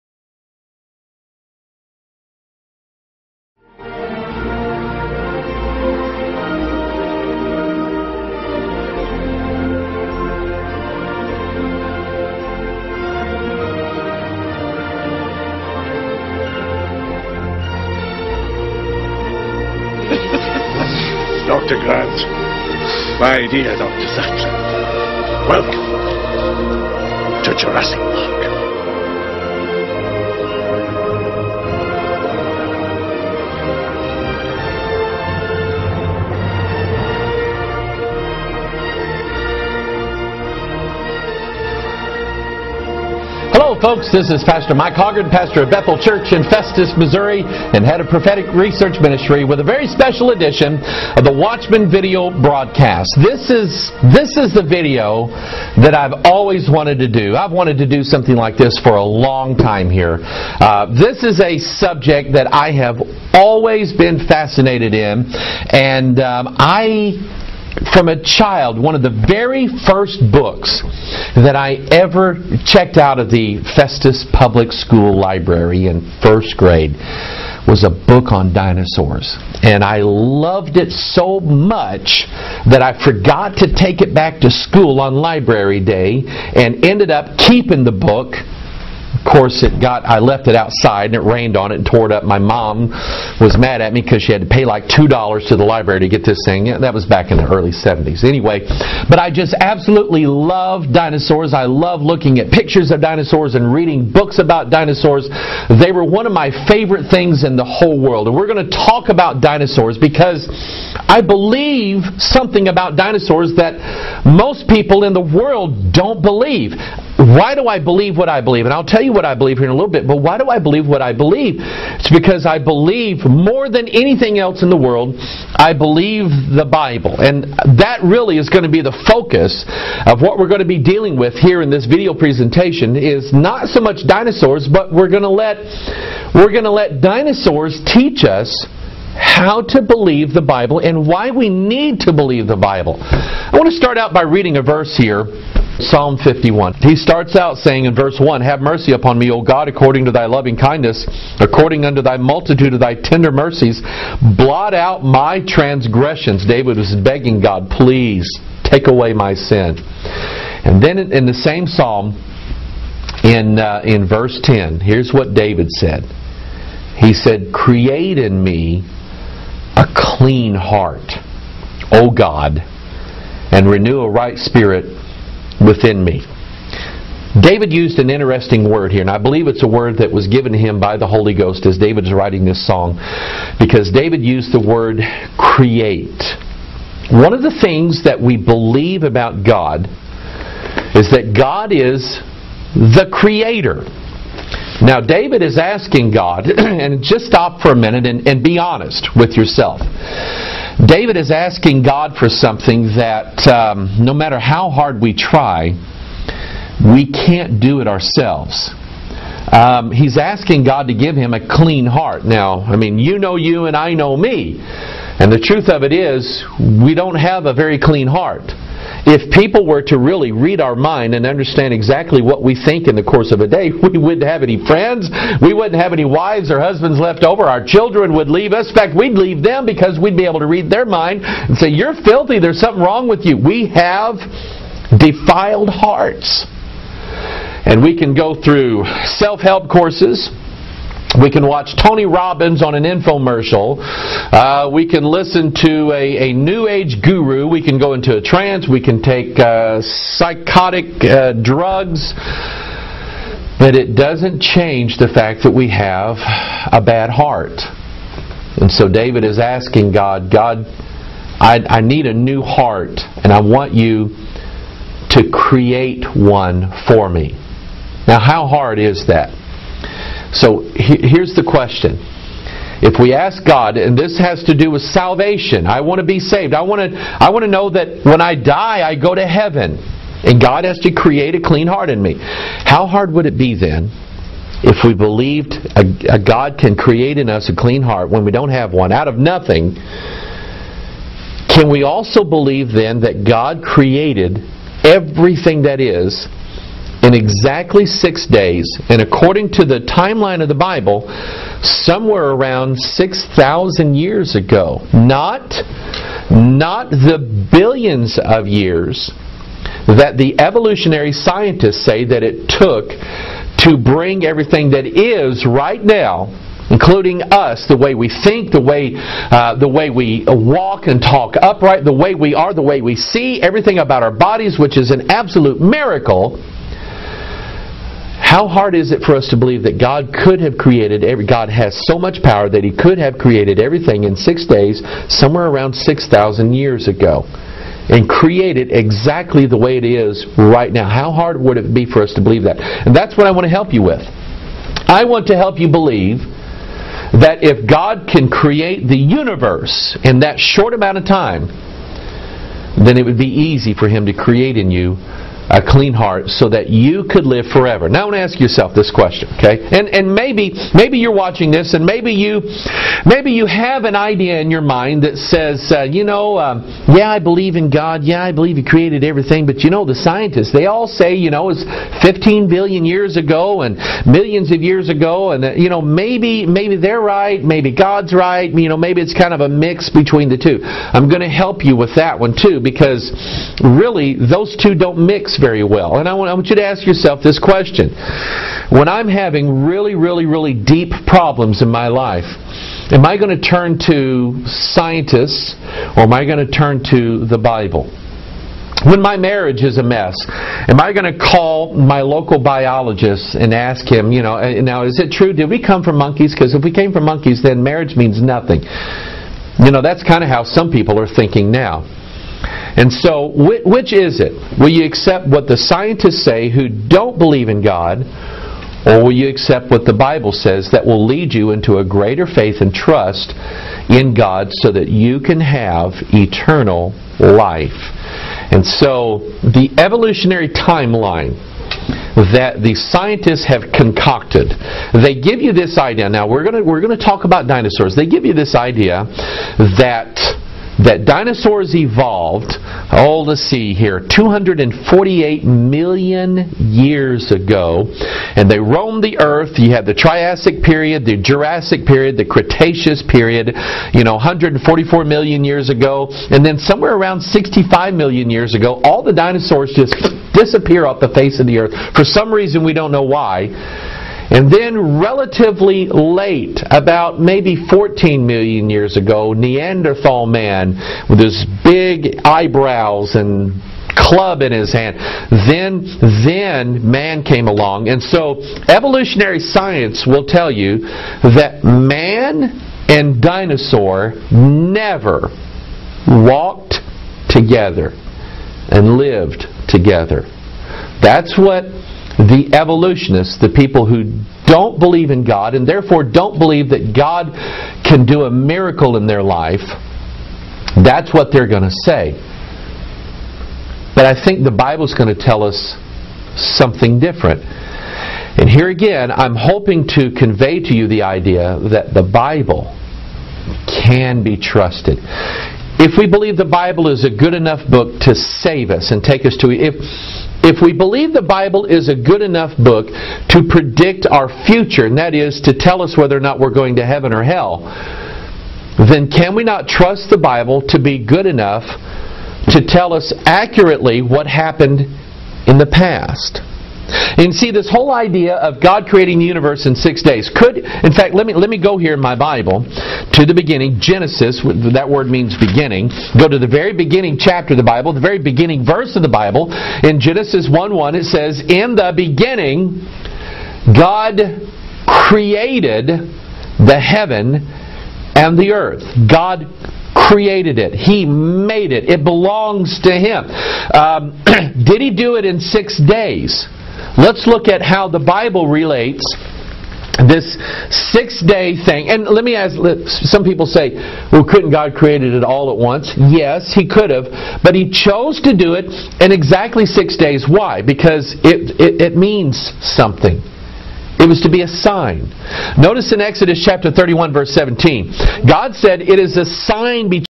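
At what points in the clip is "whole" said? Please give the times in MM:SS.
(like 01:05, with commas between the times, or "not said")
01:47, 08:57.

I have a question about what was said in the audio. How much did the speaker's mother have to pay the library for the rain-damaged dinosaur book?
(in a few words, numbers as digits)
2 dollars.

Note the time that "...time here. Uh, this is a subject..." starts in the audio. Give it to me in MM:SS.
00:59.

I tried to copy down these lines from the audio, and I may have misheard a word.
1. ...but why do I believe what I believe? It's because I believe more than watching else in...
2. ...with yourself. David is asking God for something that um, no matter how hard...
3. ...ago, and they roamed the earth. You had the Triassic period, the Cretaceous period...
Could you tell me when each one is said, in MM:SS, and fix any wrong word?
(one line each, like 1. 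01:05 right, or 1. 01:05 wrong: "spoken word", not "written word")
1. 02:00 wrong: "anything", not "watching"
2. 03:19 right
3. 07:27 wrong: "Jurassic", not "Cretaceous".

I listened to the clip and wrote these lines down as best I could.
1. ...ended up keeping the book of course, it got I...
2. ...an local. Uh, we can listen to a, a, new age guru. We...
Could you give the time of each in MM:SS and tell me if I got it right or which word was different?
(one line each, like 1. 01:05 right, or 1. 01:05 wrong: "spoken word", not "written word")
1. 01:26 right
2. 04:02 wrong: "infomercial", not "local".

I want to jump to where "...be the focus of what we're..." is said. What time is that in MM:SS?
02:08.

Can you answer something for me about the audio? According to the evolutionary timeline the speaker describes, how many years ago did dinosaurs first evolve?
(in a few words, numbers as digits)
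248 million.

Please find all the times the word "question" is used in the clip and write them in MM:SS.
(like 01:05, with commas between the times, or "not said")
04:31, 05:58, 06:27.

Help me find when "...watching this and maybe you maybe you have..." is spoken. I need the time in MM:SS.
06:01.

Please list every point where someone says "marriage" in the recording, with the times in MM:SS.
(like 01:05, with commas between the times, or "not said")
06:39, 06:47.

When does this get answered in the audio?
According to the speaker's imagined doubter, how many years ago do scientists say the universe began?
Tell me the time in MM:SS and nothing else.
06:12.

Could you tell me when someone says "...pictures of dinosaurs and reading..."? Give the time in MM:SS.
01:42.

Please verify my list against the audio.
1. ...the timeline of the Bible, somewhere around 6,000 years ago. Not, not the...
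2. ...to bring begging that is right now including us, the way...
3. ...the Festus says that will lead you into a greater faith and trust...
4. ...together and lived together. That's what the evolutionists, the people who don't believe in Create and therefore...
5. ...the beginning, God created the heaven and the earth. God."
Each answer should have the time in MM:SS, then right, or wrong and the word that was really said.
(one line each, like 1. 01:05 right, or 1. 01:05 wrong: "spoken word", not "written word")
1. 04:59 right
2. 05:13 wrong: "everything", not "begging"
3. 06:59 wrong: "Bible", not "Festus"
4. 08:07 wrong: "God", not "Create"
5. 09:11 right.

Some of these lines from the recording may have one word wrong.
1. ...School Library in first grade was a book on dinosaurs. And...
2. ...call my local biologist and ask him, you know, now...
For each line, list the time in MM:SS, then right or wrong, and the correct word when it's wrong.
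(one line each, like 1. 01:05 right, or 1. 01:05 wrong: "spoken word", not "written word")
1. 01:14 right
2. 06:41 right.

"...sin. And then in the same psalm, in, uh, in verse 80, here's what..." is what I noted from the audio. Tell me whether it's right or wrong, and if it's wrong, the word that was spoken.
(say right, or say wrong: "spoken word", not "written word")
wrong: "10", not "80".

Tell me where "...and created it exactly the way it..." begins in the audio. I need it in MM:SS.
05:37.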